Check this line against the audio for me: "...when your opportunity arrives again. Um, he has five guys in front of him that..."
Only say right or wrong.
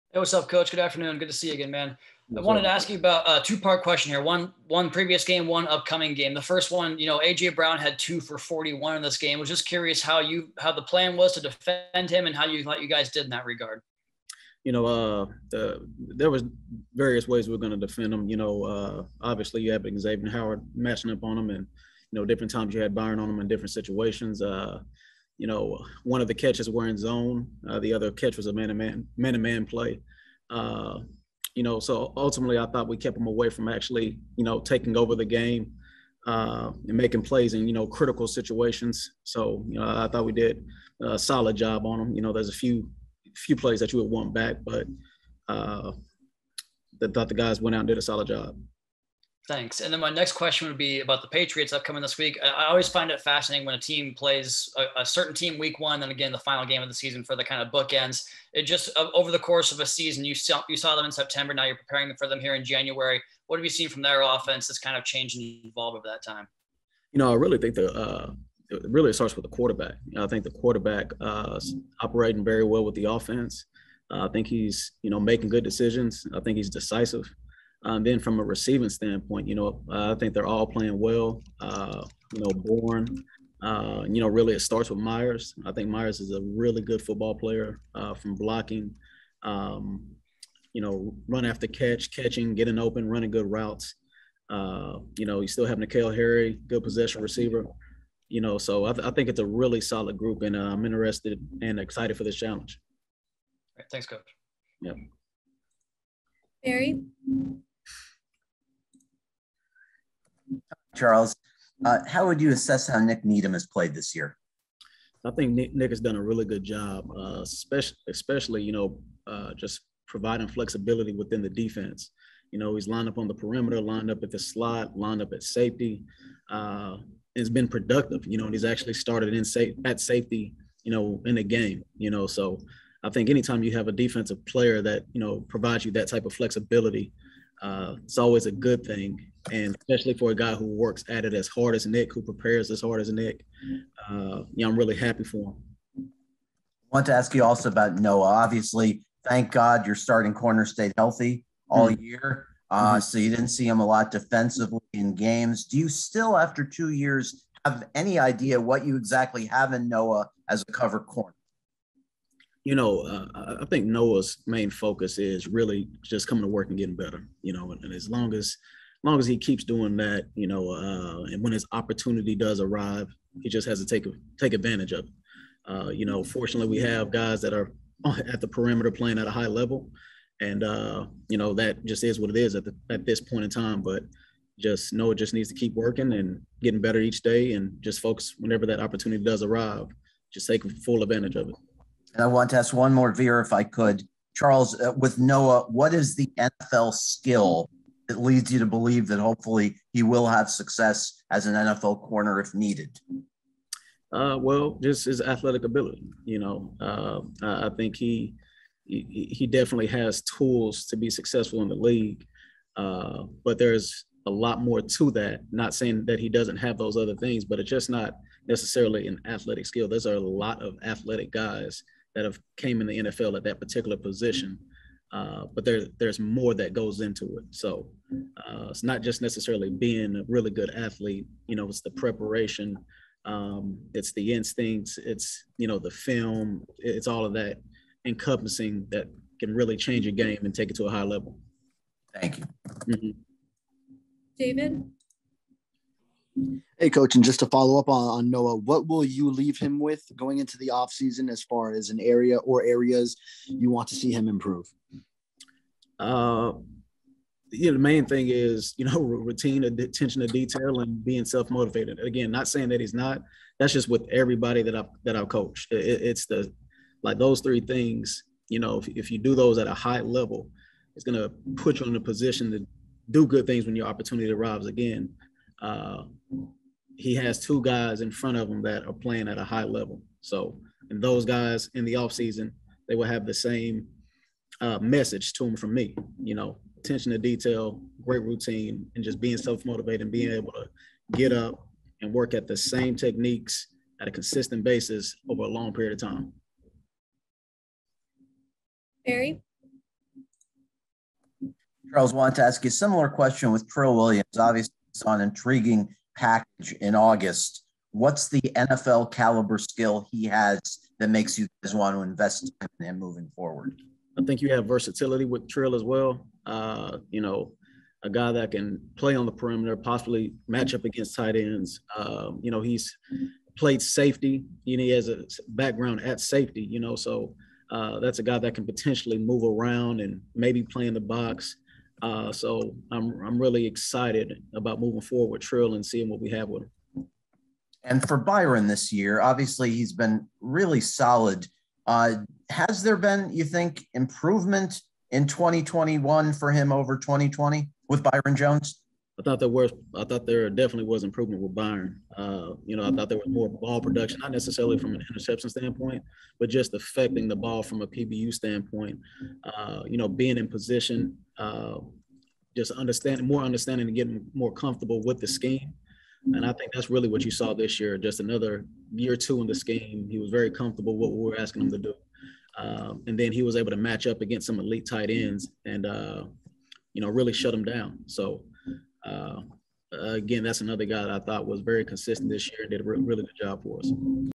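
wrong.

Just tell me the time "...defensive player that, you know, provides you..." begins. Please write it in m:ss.
2:13.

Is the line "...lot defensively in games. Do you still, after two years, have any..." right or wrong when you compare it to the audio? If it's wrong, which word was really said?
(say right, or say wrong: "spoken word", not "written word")
right.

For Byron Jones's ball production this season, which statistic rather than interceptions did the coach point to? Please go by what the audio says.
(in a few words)
PBU.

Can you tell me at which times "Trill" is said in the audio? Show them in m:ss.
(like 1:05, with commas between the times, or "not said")
5:03, 5:15, 5:35.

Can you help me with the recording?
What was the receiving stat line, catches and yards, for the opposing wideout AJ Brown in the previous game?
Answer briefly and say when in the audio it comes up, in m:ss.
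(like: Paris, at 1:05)
2 for 41, at 0:07.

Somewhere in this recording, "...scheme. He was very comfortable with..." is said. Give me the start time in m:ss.
6:09.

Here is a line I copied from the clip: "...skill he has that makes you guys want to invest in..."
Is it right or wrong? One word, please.
right.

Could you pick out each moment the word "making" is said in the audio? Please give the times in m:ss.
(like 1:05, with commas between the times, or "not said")
0:36, 1:15.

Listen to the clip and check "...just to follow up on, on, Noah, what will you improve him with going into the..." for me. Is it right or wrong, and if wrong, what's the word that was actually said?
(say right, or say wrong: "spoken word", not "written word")
wrong: "leave", not "improve".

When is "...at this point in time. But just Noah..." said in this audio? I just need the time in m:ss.
3:02.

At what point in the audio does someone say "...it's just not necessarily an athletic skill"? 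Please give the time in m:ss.
3:37.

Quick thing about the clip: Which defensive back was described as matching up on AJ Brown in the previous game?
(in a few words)
Xavier Howard.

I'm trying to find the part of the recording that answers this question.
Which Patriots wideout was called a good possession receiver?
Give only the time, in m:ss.
1:35.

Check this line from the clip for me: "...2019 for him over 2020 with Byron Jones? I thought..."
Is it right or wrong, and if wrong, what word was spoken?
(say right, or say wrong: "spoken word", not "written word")
wrong: "2021", not "2019".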